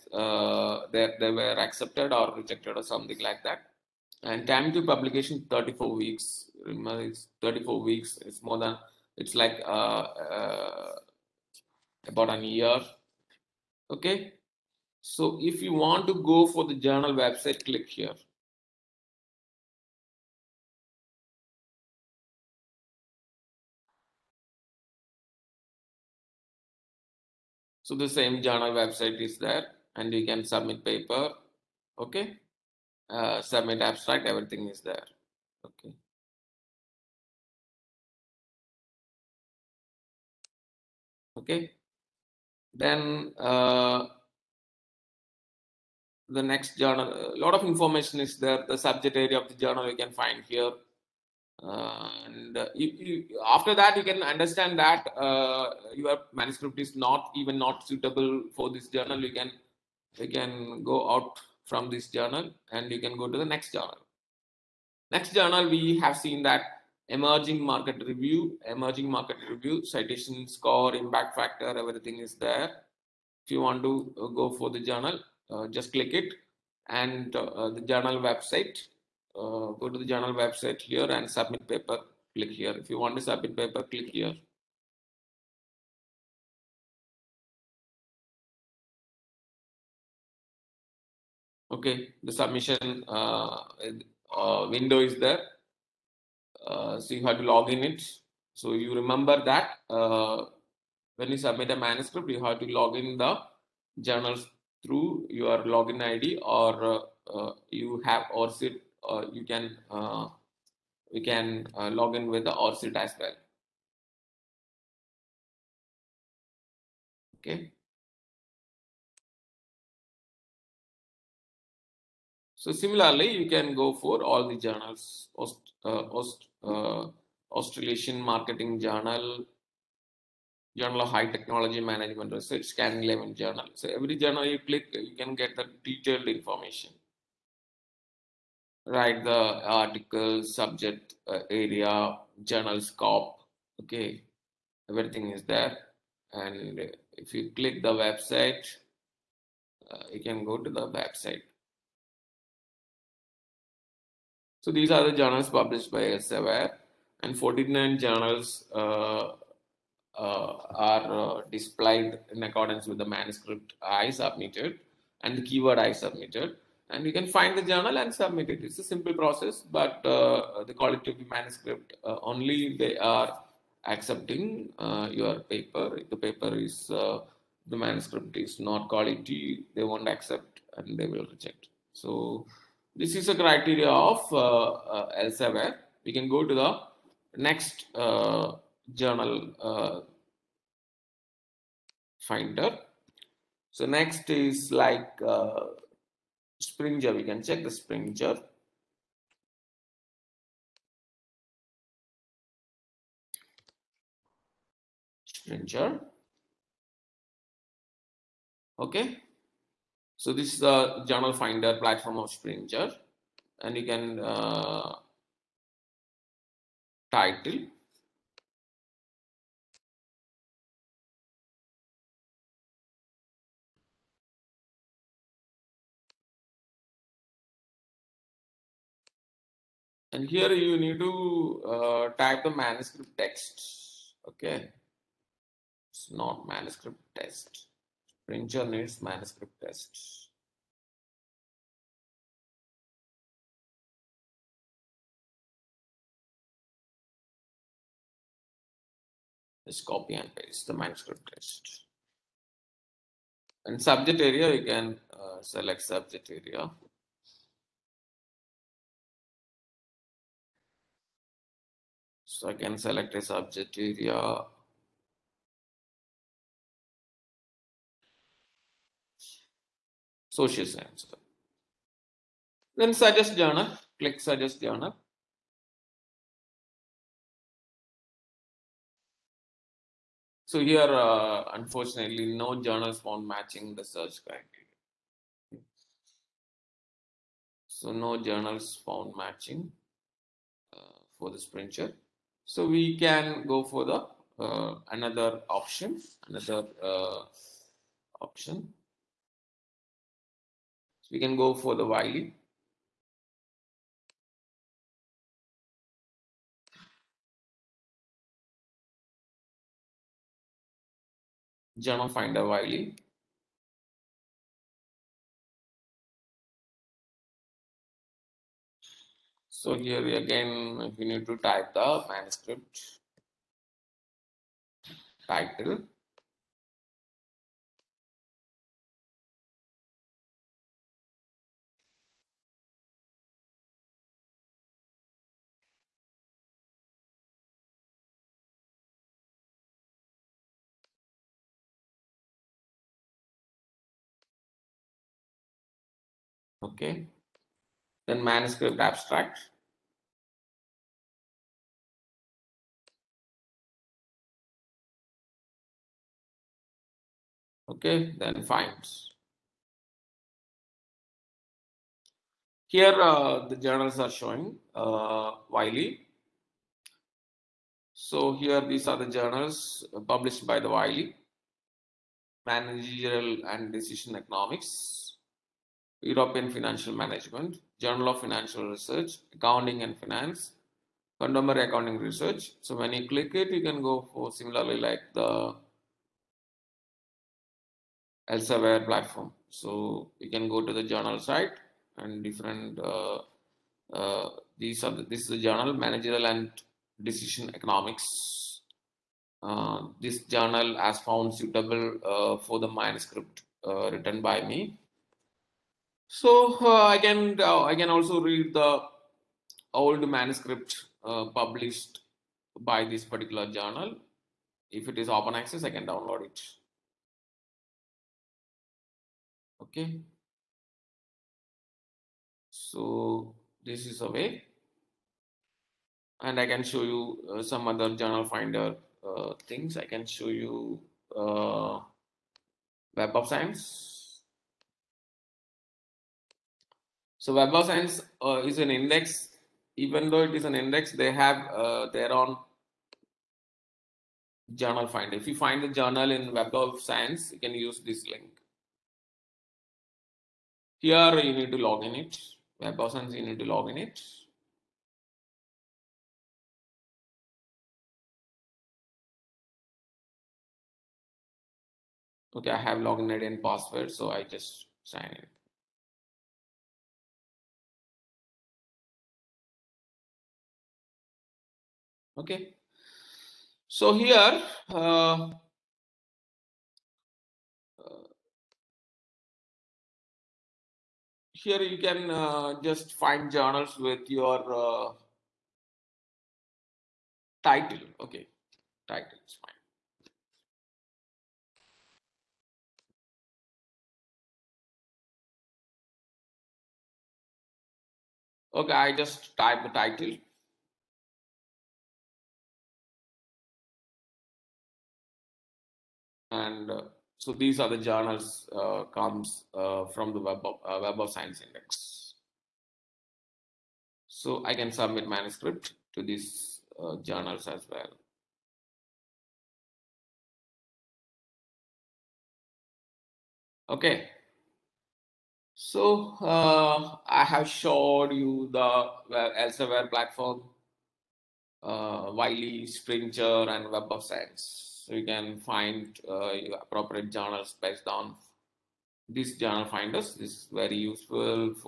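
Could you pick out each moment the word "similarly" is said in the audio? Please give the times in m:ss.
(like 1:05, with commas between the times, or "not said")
2:02, 6:24.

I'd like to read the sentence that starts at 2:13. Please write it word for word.
So every journal you click, you can get the detailed information write the article, subject uh, area, journal scope.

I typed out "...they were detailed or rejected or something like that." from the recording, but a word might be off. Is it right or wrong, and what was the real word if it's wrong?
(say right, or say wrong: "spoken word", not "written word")
wrong: "accepted", not "detailed".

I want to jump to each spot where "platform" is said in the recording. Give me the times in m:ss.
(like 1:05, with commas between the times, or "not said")
3:31, 6:28, 8:49.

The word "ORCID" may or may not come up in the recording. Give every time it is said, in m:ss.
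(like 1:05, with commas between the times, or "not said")
1:48, 1:52.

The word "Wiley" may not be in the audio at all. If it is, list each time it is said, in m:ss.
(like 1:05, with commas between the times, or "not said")
6:05, 6:10, 8:52.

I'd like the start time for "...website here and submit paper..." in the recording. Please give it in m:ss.
1:20.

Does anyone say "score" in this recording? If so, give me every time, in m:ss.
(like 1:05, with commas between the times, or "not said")
1:10.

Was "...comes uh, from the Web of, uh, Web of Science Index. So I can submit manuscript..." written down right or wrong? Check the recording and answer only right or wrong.
right.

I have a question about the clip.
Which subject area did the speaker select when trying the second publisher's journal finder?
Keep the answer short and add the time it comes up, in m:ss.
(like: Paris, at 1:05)
Social science, at 4:30.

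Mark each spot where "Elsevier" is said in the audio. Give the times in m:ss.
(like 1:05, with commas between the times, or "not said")
2:36, 3:05, 6:28, 8:49.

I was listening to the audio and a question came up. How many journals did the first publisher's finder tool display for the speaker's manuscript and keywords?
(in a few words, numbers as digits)
49.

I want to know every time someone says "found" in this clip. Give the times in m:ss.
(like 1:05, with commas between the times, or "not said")
4:42, 4:48, 6:40.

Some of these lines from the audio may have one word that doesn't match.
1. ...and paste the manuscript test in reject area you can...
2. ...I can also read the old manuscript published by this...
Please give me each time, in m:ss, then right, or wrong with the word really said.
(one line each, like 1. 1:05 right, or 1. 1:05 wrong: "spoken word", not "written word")
1. 4:10 wrong: "subject", not "reject"
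2. 6:47 right.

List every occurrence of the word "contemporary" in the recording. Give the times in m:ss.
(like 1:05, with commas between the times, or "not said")
6:21.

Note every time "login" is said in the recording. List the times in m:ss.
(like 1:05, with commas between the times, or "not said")
1:45, 7:42.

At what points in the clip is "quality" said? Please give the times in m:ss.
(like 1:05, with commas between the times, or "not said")
2:50, 2:58.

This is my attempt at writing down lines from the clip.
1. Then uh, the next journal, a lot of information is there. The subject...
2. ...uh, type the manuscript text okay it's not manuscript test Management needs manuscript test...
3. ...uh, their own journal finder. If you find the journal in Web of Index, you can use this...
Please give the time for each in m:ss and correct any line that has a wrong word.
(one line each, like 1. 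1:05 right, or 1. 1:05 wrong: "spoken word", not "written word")
1. 0:42 right
2. 3:51 wrong: "Springer", not "Management"
3. 7:21 wrong: "Science", not "Index".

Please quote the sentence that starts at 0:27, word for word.
So the same journal website is there and you can submit paper.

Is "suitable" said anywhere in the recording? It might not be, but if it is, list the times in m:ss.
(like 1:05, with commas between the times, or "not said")
0:57, 6:41.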